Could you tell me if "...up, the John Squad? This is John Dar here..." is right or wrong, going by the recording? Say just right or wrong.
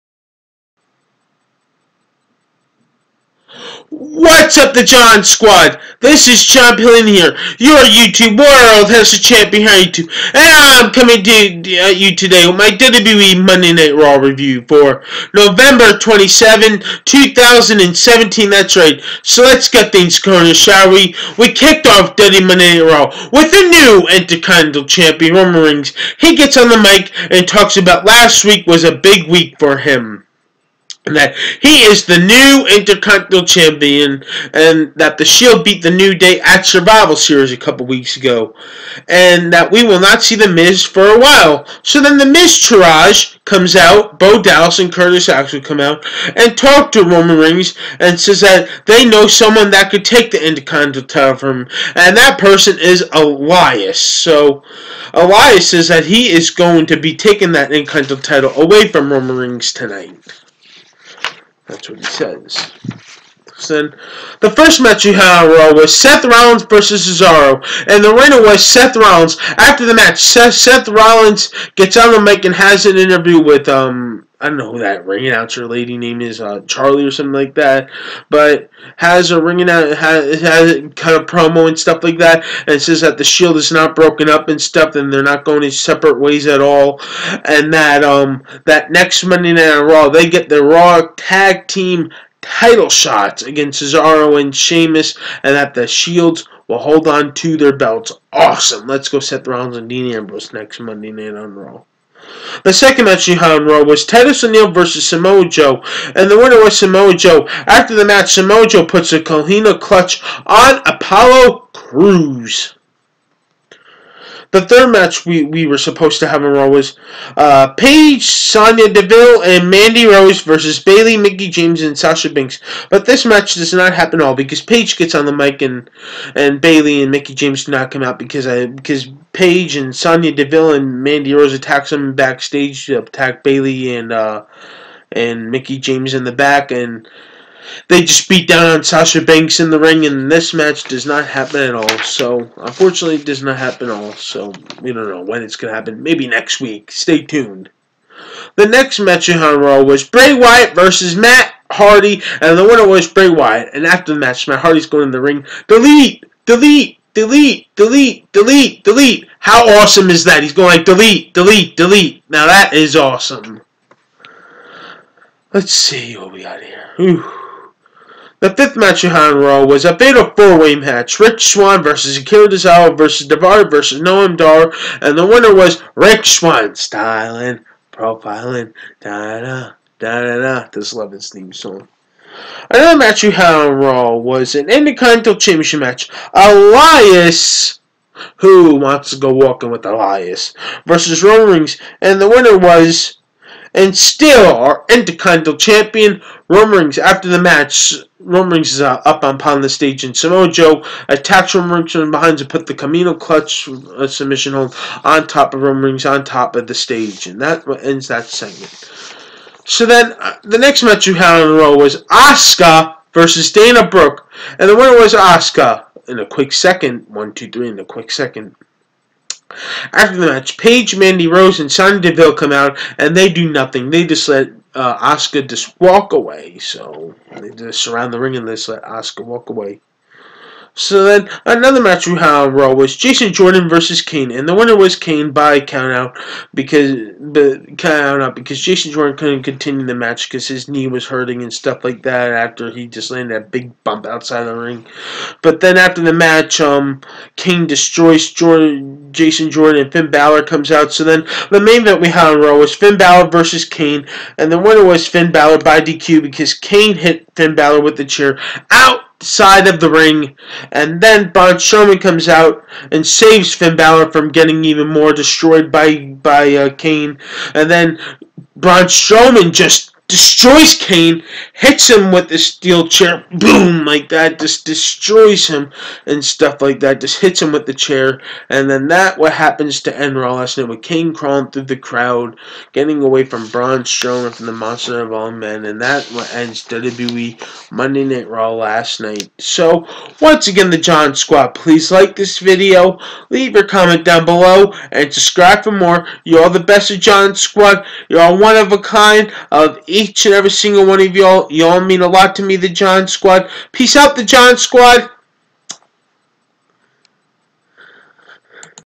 wrong.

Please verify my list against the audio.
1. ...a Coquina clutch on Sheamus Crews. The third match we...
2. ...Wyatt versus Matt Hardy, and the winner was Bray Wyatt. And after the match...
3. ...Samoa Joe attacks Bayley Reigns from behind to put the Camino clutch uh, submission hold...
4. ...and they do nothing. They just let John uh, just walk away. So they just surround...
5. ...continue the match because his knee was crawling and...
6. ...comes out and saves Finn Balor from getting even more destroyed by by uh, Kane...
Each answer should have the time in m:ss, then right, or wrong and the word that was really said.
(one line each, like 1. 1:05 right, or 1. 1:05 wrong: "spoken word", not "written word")
1. 1:49 wrong: "Apollo", not "Sheamus"
2. 2:30 right
3. 3:20 wrong: "Roman", not "Bayley"
4. 3:42 wrong: "Asuka", not "John"
5. 3:59 wrong: "hurting", not "crawling"
6. 4:22 right.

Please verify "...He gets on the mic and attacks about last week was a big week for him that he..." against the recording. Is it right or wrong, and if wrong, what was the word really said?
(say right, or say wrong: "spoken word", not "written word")
wrong: "talks", not "attacks".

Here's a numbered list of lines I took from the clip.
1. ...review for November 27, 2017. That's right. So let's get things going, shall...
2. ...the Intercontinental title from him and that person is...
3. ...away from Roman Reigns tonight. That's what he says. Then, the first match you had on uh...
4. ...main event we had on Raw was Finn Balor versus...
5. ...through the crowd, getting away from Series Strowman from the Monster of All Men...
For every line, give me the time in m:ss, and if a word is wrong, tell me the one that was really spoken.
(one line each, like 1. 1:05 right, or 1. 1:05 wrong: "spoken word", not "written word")
1. 0:14 right
2. 0:50 right
3. 0:58 right
4. 4:11 right
5. 4:41 wrong: "Braun", not "Series".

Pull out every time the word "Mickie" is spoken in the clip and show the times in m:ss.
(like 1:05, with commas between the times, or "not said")
2:01, 2:07, 2:15.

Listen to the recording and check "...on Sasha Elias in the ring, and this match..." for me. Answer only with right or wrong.
wrong.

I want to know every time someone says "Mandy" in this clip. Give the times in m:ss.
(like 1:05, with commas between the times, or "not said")
1:59, 2:11, 3:40.